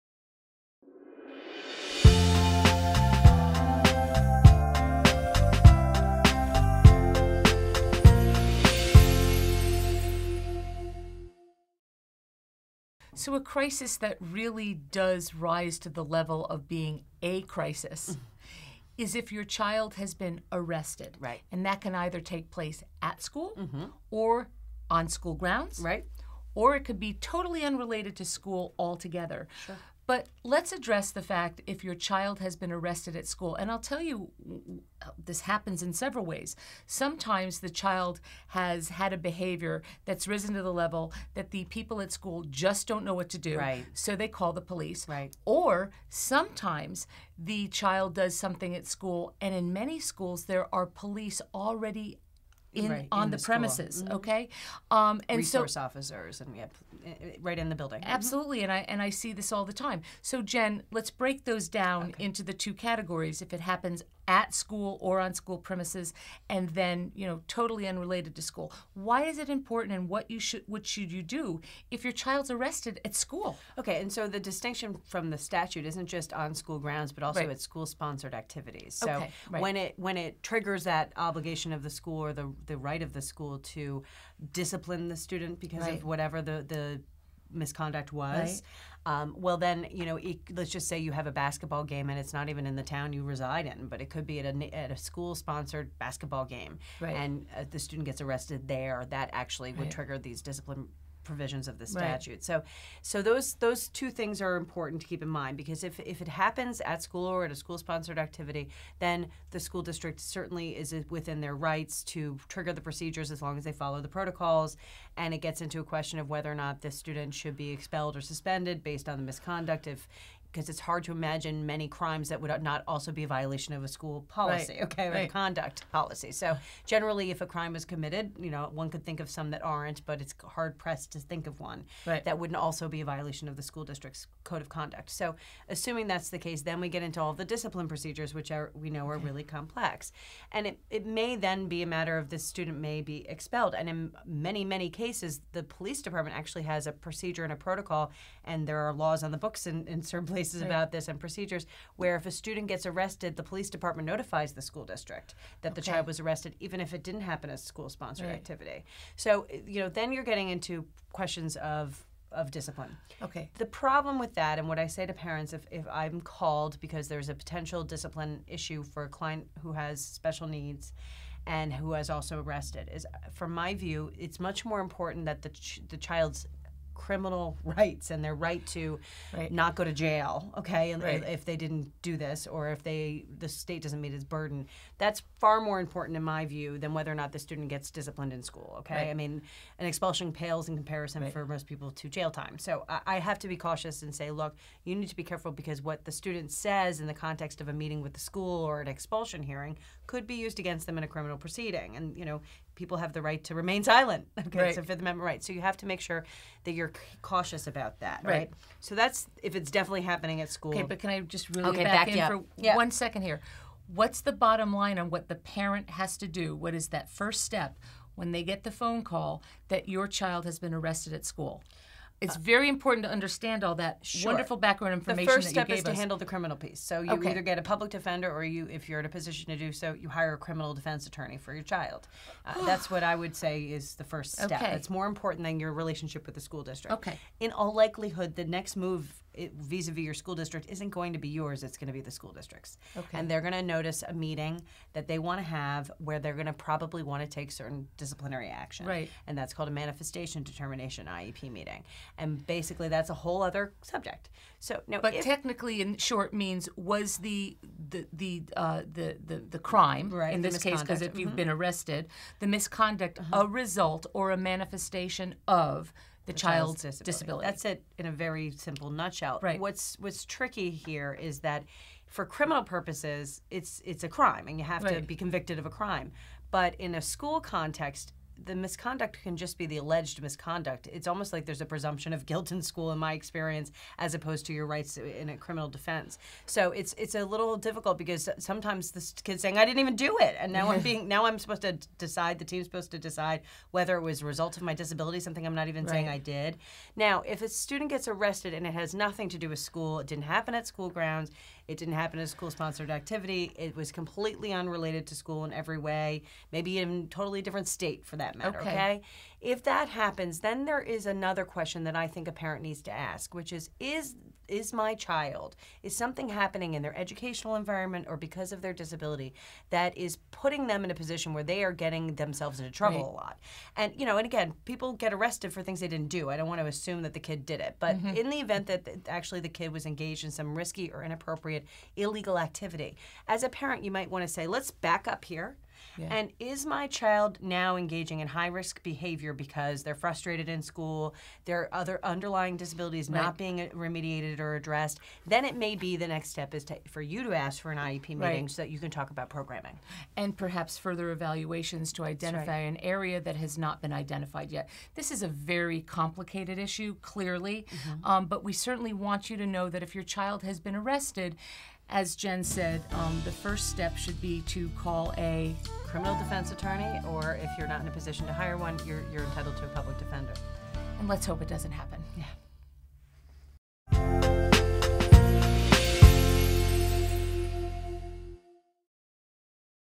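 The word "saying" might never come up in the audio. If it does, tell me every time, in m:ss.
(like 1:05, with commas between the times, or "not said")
4:49, 4:55.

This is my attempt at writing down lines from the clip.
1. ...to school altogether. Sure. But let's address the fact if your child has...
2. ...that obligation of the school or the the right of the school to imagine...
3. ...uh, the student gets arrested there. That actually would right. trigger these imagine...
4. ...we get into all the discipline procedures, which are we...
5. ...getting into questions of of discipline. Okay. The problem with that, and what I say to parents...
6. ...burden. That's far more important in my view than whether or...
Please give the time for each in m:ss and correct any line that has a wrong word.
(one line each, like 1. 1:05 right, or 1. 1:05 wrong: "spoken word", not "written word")
1. 0:28 right
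2. 1:20 wrong: "discipline", not "imagine"
3. 1:37 wrong: "discipline", not "imagine"
4. 2:16 right
5. 2:40 right
6. 3:04 right.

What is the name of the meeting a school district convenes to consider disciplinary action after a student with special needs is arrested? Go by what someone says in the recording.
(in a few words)
manifestation determination IEP meeting.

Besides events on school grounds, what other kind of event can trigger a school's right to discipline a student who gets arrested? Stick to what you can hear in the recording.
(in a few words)
school sponsored activities.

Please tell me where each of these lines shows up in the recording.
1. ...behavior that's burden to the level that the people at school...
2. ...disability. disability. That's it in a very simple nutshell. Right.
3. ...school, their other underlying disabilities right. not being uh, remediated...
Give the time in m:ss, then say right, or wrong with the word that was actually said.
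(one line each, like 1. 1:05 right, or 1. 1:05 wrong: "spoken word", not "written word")
1. 0:39 wrong: "risen", not "burden"
2. 4:26 right
3. 5:40 right.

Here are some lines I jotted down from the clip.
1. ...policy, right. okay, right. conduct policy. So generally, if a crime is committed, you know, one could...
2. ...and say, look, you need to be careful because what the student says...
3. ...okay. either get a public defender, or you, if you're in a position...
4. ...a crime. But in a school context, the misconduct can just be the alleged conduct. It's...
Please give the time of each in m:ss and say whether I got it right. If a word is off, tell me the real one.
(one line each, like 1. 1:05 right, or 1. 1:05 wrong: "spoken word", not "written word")
1. 2:04 right
2. 3:14 right
3. 3:47 right
4. 4:35 wrong: "misconduct", not "conduct".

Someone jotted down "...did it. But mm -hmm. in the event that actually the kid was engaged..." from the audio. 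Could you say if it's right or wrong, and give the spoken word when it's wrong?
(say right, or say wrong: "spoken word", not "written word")
right.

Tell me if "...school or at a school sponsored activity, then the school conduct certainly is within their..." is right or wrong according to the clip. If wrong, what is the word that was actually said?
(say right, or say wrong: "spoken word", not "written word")
wrong: "district", not "conduct".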